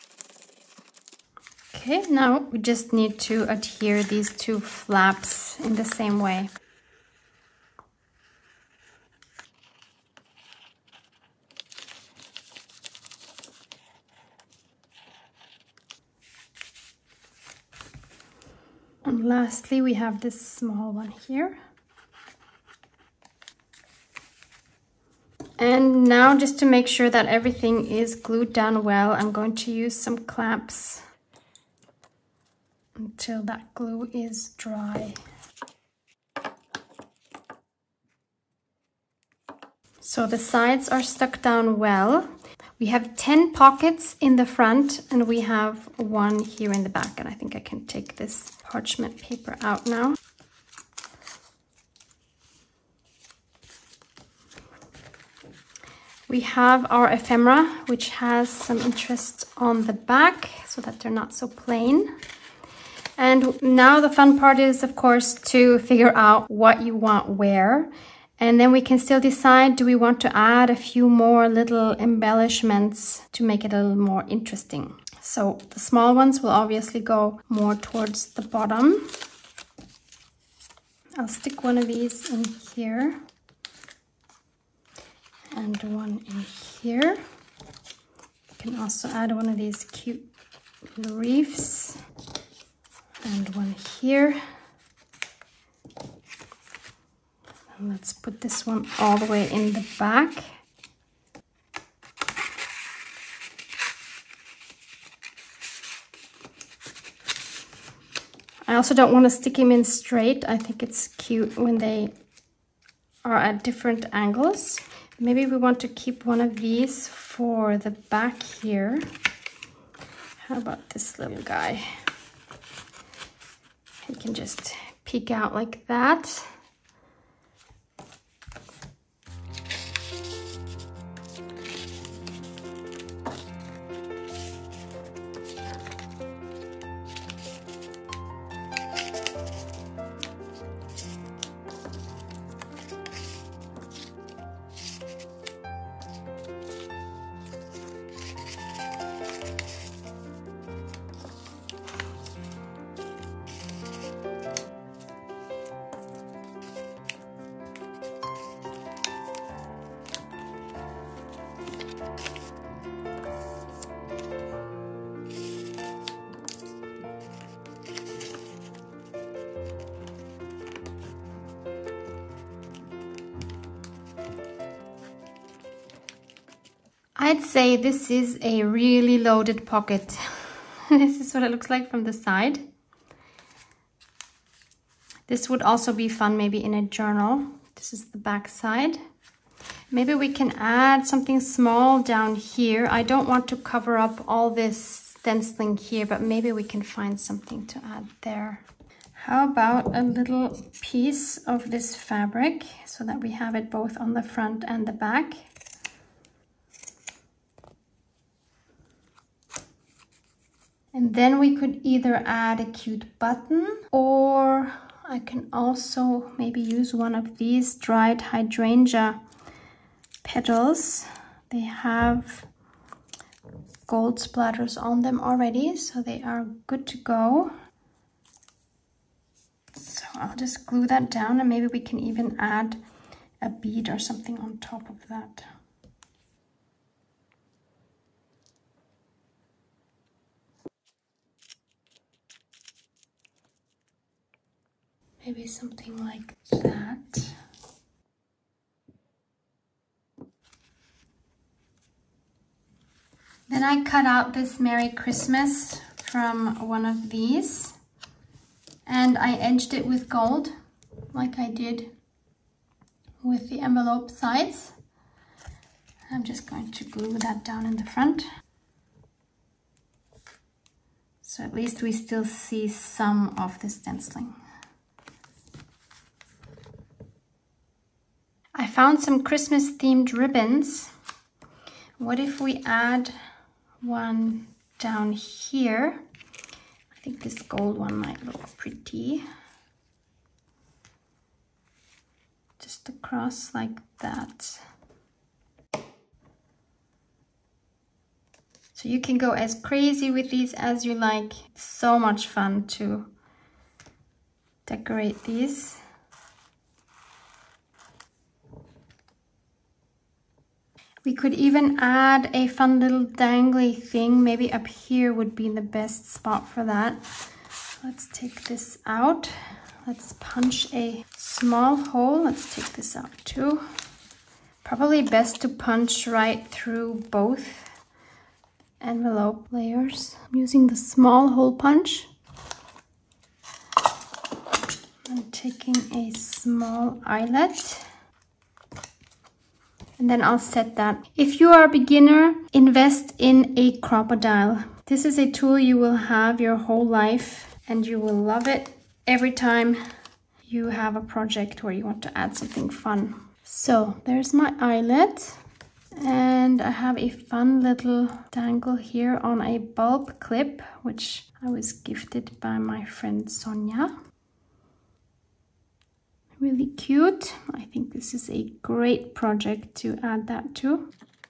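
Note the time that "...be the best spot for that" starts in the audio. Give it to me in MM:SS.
05:15.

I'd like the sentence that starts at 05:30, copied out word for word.
I'm using the small hole punch.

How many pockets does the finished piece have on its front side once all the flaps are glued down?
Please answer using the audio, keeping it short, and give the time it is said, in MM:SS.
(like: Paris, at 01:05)
10, at 00:43.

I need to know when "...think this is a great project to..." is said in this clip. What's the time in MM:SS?
06:07.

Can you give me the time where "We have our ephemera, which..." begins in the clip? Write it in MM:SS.
00:56.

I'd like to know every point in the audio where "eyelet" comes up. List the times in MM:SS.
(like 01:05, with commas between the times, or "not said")
05:37, 05:54.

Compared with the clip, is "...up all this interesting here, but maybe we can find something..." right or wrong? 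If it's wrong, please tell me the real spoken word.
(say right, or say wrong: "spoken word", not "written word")
wrong: "stenciling", not "interesting".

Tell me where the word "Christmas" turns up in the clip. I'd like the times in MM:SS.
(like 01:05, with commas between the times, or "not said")
04:14, 04:39.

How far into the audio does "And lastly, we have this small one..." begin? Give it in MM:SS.
00:19.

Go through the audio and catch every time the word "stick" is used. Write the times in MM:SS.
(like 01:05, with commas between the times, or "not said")
01:21, 01:49.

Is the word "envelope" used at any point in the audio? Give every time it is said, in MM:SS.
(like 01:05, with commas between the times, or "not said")
04:23, 05:28.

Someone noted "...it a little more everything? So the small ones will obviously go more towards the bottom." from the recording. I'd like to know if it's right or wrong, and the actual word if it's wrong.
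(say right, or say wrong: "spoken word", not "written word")
wrong: "interesting", not "everything".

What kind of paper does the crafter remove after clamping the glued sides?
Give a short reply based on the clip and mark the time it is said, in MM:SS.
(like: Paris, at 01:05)
Parchment paper, at 00:48.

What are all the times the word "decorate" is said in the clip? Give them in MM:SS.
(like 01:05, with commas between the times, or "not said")
05:04.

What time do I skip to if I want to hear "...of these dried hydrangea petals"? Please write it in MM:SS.
03:37.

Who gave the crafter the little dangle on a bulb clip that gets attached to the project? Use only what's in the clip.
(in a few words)
Sonia.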